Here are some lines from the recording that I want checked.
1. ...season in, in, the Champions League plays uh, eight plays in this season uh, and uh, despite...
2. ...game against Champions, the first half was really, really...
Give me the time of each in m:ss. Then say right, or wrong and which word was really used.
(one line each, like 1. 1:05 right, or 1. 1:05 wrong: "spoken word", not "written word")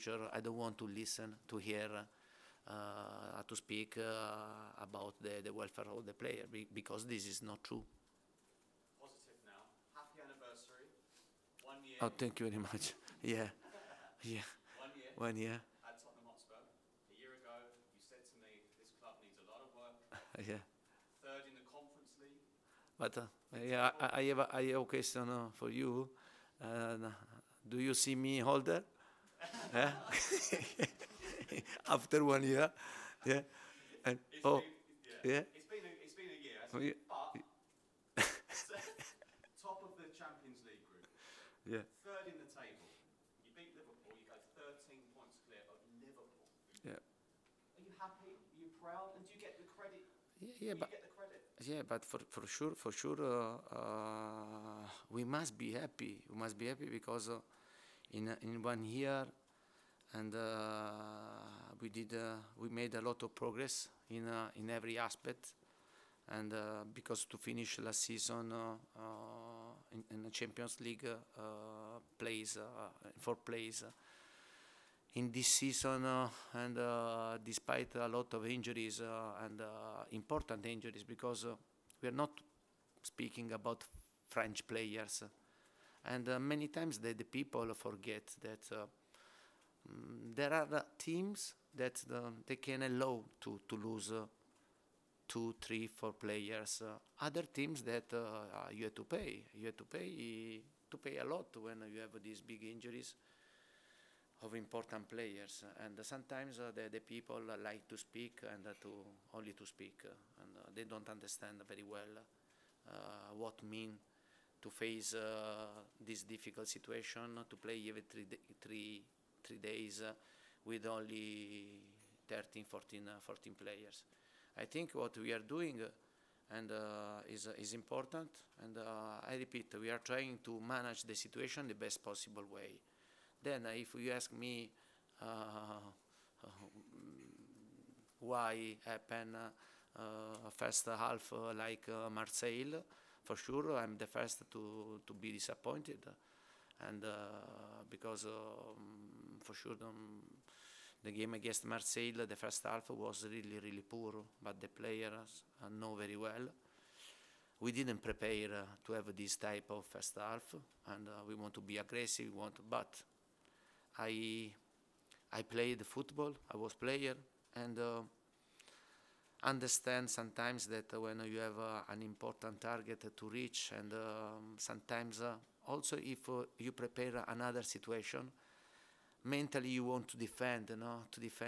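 1. 1:08 wrong: "four", not "eight"
2. 2:31 wrong: "Marseille", not "Champions".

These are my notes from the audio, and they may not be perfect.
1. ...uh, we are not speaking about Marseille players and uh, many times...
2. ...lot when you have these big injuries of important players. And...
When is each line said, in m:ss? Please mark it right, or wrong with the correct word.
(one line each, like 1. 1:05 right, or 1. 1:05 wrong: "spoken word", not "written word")
1. 1:21 wrong: "French", not "Marseille"
2. 1:41 right.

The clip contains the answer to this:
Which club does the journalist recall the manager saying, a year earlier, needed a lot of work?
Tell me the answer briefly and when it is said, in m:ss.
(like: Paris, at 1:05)
Tottenham Hotspur, at 0:16.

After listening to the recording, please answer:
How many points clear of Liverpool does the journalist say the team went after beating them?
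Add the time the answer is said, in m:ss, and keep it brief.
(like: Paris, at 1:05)
13, at 0:44.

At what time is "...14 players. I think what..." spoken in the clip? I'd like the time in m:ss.
2:03.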